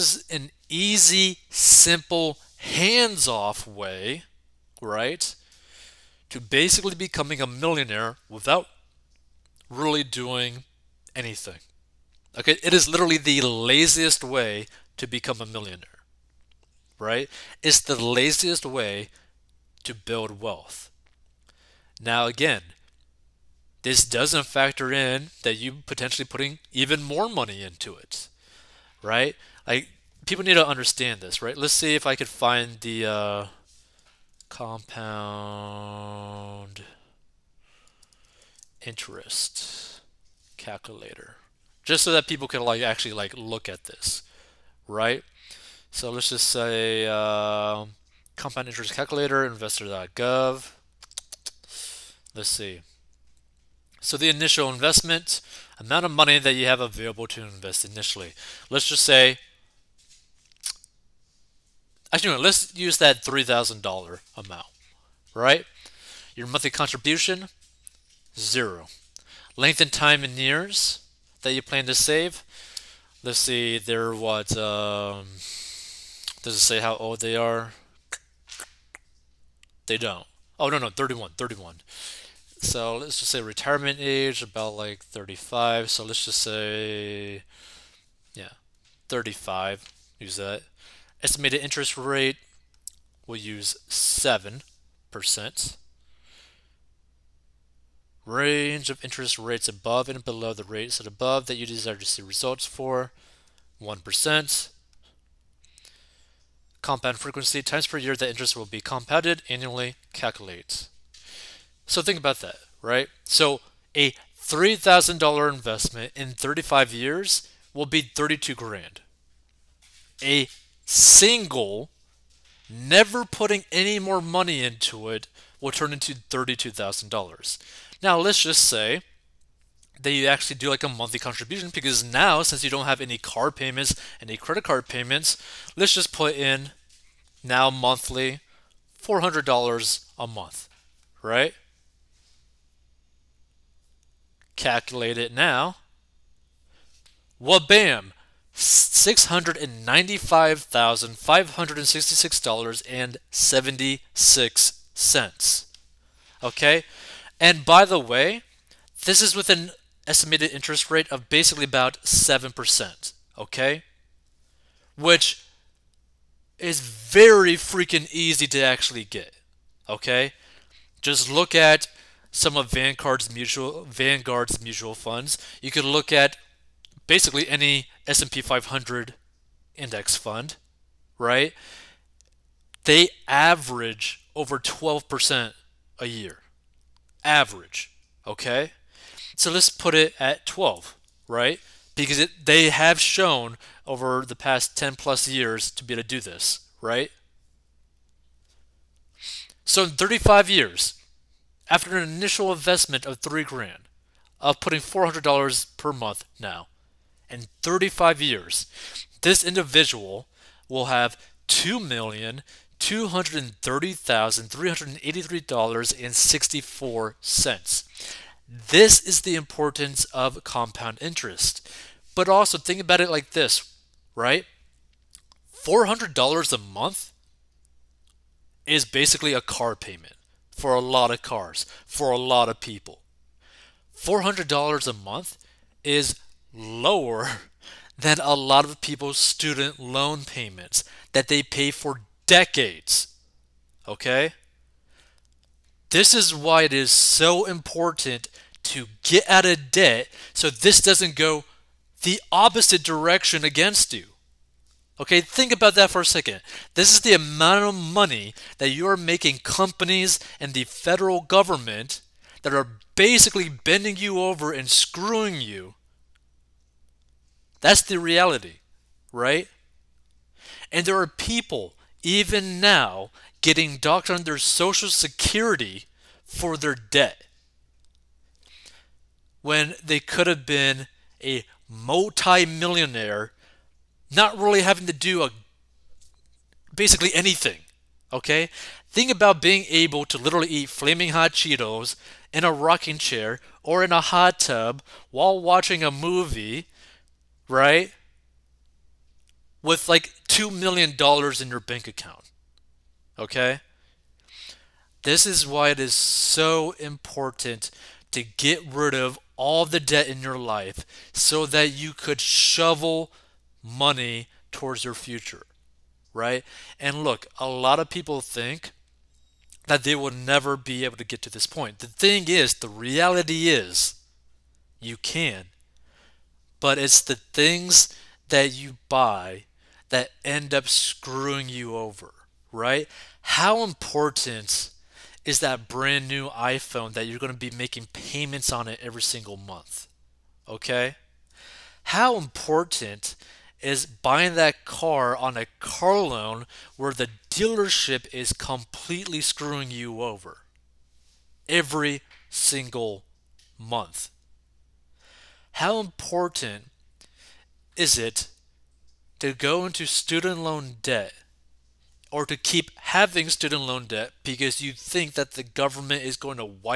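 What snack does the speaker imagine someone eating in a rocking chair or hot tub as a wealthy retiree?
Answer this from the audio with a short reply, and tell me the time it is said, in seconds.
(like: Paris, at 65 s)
Flaming Hot Cheetos, at 290 s.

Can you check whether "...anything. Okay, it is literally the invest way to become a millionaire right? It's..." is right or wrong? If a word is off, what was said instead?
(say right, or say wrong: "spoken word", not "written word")
wrong: "laziest", not "invest".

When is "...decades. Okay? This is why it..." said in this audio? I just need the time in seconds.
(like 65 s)
242 s.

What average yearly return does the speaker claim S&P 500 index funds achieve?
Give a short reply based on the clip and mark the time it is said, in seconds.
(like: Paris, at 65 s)
over 12%, at 184 s.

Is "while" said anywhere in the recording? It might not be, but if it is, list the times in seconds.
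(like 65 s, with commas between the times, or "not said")
295 s.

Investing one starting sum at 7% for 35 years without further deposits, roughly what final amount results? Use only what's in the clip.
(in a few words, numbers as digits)
$32,000.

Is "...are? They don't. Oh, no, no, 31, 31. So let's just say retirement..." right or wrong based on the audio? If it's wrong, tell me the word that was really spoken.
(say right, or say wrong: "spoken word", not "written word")
right.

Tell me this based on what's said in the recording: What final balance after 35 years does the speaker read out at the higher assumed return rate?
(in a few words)
$2,230,383.64.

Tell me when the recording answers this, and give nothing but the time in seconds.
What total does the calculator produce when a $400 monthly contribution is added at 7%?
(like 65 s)
148 s.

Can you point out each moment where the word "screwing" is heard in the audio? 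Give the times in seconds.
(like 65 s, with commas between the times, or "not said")
264 s, 330 s, 349 s.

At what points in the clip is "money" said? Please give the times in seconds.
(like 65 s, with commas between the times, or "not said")
27 s, 56 s, 124 s, 257 s, 313 s.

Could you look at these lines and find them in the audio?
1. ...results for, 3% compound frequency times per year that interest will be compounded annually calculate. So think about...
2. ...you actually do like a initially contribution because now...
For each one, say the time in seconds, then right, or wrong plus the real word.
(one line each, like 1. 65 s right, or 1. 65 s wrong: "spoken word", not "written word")
1. 102 s wrong: "1", not "3"
2. 130 s wrong: "monthly", not "initially".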